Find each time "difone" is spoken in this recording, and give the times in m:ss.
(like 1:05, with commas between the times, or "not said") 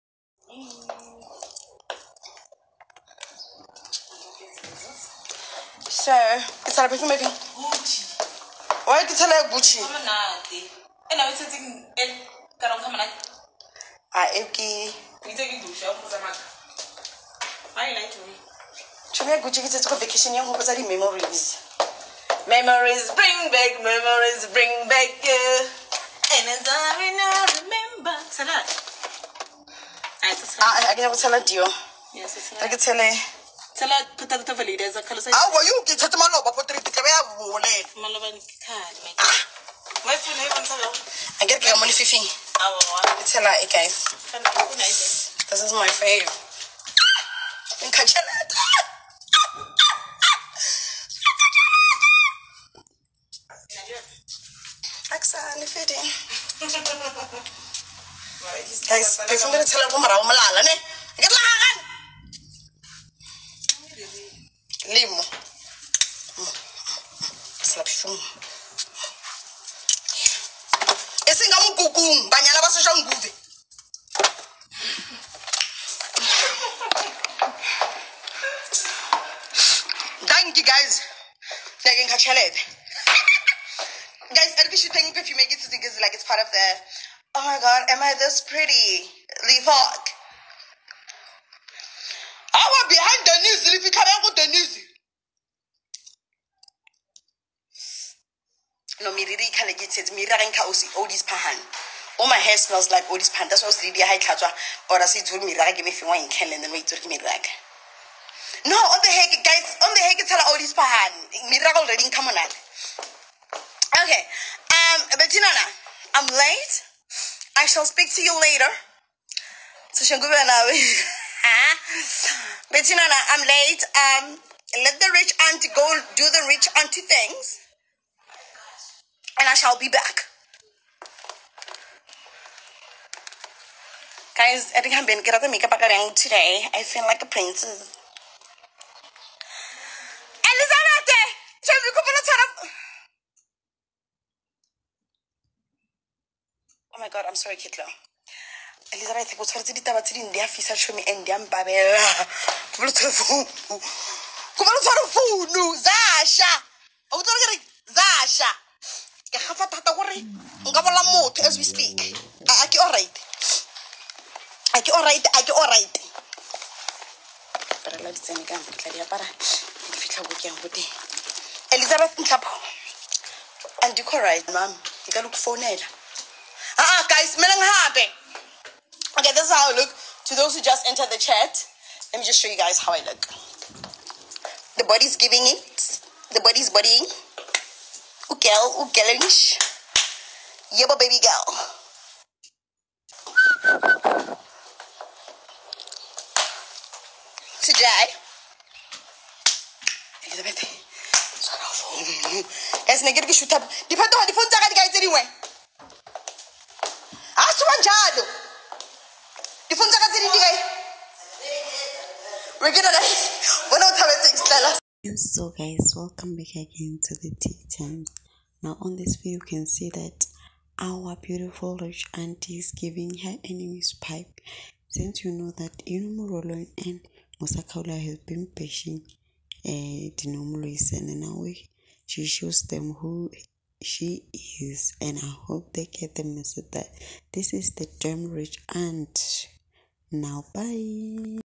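3:24, 3:29.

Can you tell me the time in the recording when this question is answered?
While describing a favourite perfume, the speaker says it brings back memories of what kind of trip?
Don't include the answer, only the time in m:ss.
0:20.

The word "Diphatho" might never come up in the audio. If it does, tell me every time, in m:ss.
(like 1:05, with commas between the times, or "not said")
3:23.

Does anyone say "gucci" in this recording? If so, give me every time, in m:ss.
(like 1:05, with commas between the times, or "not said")
0:09, 0:19.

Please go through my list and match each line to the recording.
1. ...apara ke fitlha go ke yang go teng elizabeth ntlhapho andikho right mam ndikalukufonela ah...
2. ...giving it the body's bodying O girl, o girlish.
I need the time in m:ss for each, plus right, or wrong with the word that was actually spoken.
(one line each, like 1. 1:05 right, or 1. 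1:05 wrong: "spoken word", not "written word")
1. 2:48 right
2. 3:05 right.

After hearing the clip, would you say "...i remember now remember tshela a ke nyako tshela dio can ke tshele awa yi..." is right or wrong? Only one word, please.
right.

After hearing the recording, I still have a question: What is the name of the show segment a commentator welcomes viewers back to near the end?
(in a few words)
Tea Time.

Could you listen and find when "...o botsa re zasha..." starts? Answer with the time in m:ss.
2:37.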